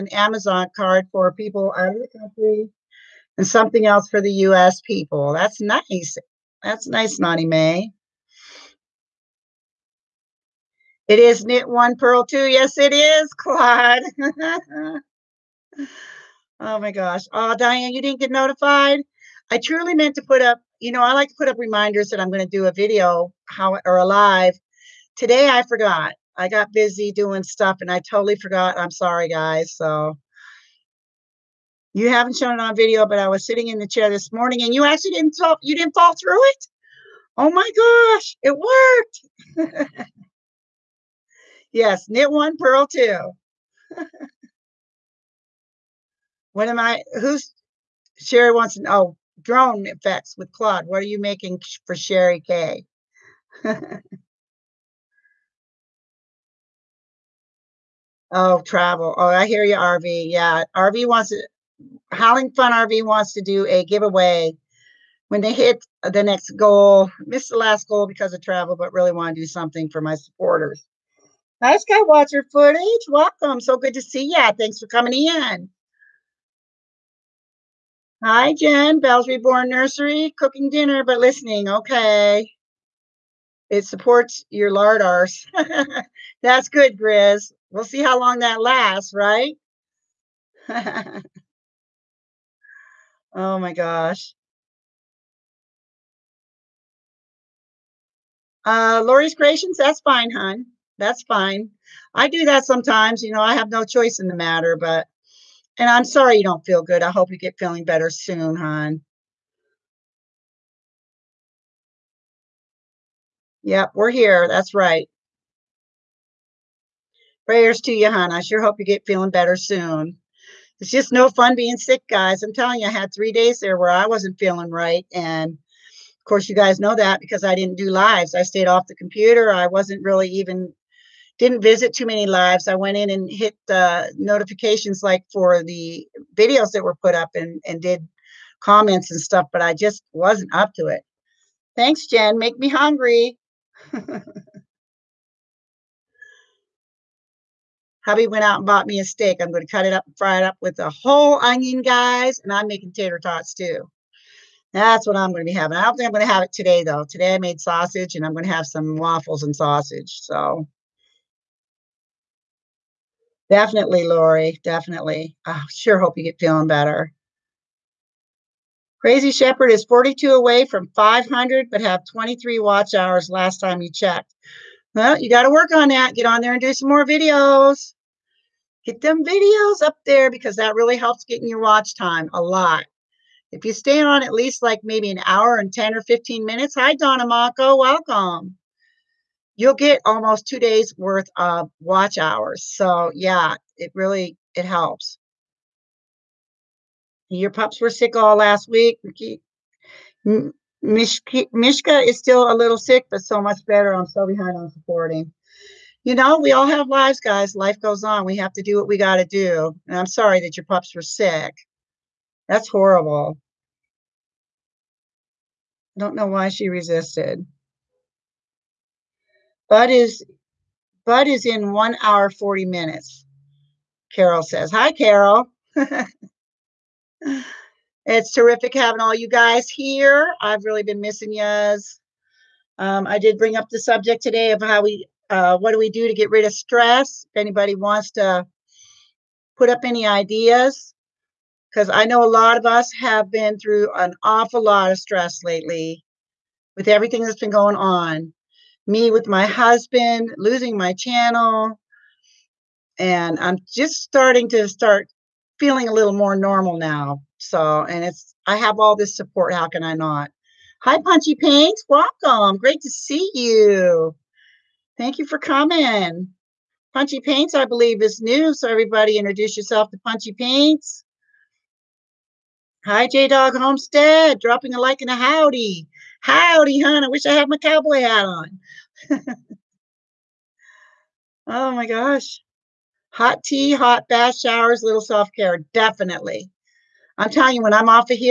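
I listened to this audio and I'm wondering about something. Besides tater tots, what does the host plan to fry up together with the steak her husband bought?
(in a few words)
a whole onion.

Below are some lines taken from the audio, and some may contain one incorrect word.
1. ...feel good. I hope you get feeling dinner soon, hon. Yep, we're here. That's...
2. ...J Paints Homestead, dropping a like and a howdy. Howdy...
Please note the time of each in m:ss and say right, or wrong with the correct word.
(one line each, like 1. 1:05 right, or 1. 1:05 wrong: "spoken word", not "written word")
1. 1:46 wrong: "better", not "dinner"
2. 4:33 wrong: "Dog", not "Paints".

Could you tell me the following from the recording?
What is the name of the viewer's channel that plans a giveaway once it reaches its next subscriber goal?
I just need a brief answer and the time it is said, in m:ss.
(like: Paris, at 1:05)
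Howling Fun RV, at 1:02.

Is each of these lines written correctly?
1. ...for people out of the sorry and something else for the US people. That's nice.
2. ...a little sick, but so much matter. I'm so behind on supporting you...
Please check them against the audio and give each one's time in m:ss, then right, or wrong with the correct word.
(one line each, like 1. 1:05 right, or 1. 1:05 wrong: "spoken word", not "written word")
1. 0:01 wrong: "country", not "sorry"
2. 3:22 wrong: "better", not "matter".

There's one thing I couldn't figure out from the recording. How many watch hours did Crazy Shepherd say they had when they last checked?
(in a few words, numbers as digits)
23.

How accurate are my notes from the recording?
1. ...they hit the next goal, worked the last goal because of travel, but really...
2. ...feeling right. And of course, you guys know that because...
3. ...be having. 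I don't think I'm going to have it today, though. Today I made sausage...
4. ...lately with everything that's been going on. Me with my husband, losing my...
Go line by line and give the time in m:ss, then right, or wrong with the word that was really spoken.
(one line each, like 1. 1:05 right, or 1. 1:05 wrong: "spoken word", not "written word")
1. 1:05 wrong: "missed", not "worked"
2. 2:04 right
3. 2:35 right
4. 4:05 right.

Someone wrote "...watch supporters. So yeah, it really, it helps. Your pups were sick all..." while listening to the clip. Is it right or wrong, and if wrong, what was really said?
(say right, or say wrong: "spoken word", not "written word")
wrong: "hours", not "supporters".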